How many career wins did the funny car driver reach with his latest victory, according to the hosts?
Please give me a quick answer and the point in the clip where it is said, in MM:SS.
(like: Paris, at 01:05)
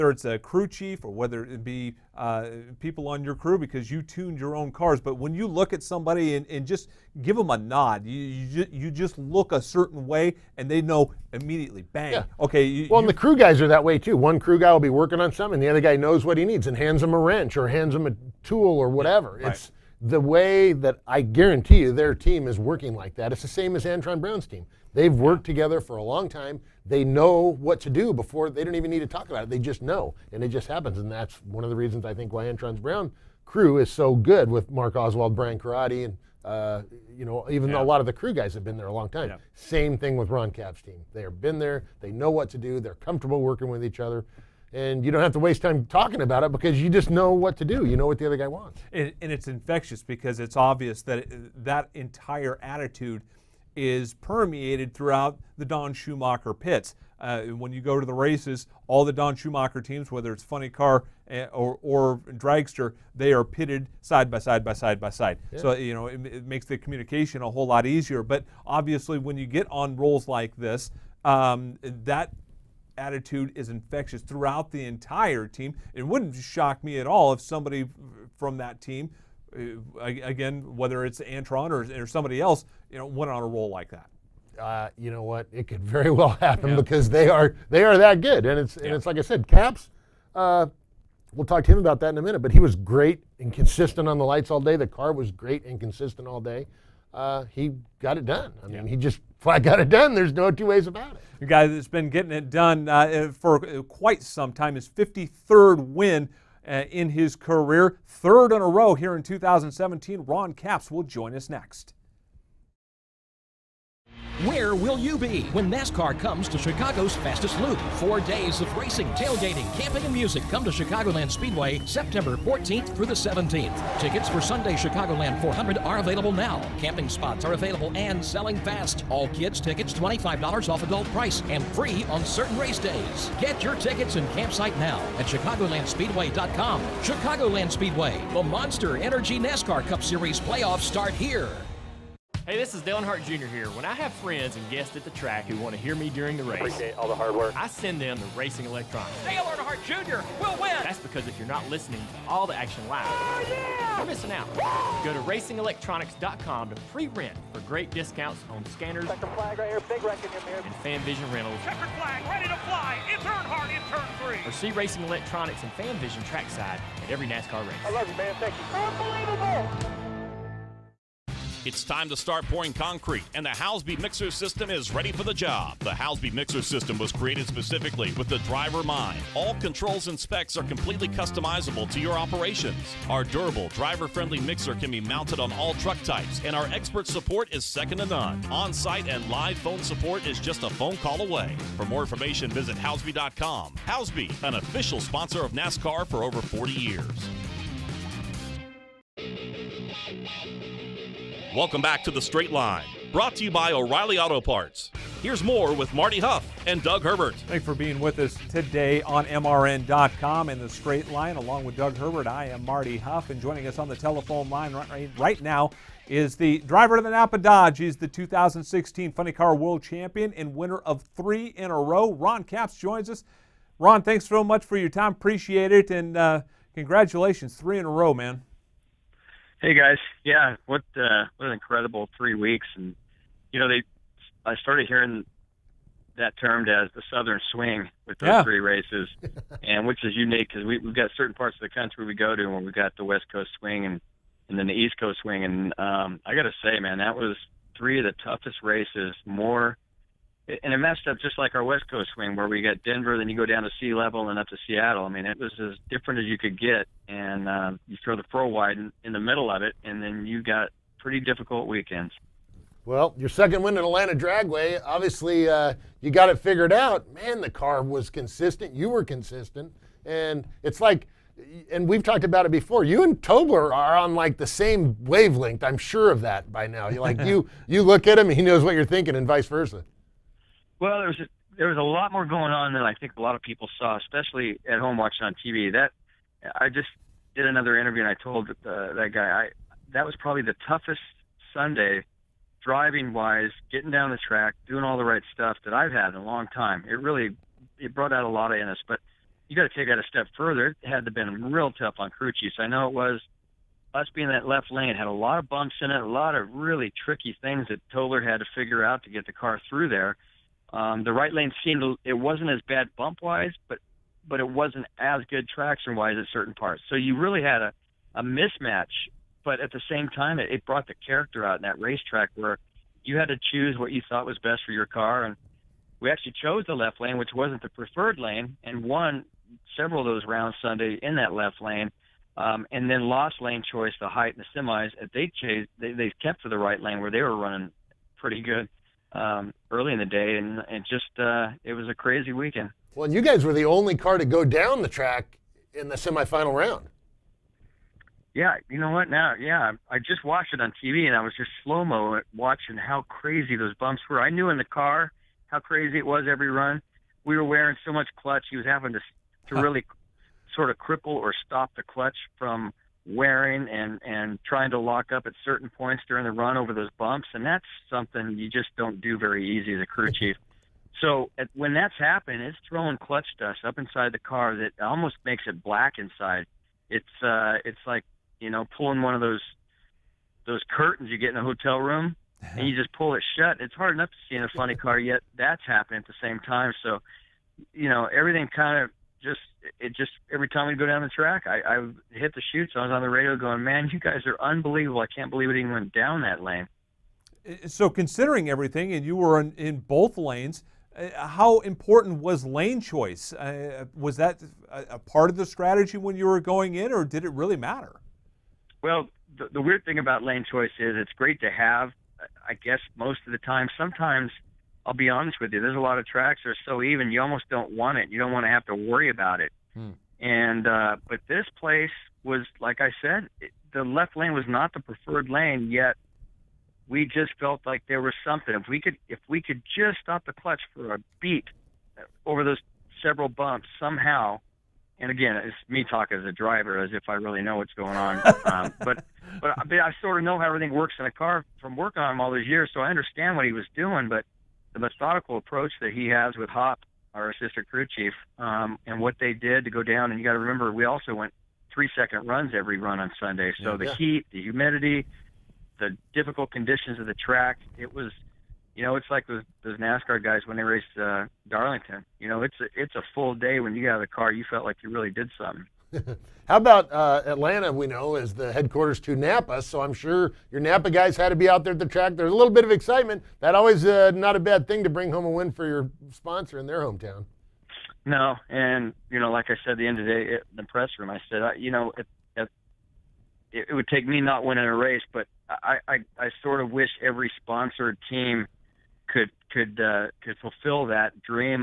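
53, at 01:44.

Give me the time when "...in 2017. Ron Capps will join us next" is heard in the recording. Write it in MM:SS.
01:49.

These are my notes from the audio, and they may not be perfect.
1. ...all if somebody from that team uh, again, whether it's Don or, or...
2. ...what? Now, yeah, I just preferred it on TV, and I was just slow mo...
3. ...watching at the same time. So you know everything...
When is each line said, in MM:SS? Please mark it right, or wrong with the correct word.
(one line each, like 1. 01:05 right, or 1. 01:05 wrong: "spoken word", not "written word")
1. 01:17 wrong: "Antron", not "Don"
2. 05:48 wrong: "watched", not "preferred"
3. 06:25 wrong: "happening", not "watching".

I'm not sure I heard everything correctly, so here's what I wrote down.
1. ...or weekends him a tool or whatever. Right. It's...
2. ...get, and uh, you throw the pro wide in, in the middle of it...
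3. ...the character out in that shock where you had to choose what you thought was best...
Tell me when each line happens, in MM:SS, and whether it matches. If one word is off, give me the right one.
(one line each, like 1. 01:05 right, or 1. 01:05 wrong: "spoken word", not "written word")
1. 00:17 wrong: "hands", not "weekends"
2. 04:16 right
3. 05:20 wrong: "racetrack", not "shock".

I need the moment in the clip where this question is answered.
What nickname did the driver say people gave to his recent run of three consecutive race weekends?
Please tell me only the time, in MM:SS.
03:57.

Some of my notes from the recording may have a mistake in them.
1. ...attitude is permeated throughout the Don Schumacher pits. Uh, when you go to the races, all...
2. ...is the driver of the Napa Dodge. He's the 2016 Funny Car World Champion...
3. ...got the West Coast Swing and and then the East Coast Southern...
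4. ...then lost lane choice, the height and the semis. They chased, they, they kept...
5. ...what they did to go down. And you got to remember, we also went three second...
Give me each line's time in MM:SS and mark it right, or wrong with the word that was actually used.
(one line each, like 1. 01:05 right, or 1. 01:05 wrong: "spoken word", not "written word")
1. 00:52 right
2. 03:36 right
3. 04:02 wrong: "Swing", not "Southern"
4. 05:32 right
5. 07:28 right.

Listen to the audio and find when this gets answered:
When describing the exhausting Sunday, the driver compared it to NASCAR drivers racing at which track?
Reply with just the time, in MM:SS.
07:41.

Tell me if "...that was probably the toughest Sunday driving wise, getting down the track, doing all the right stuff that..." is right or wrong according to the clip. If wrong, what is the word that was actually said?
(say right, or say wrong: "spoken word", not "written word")
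right.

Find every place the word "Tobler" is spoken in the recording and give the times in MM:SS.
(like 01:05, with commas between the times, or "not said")
04:33, 05:07.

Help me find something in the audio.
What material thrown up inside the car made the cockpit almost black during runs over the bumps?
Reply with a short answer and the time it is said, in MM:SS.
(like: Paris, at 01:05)
Clutch dust, at 06:12.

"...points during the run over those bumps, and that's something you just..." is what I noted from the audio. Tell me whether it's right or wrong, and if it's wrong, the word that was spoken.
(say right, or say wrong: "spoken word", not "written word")
right.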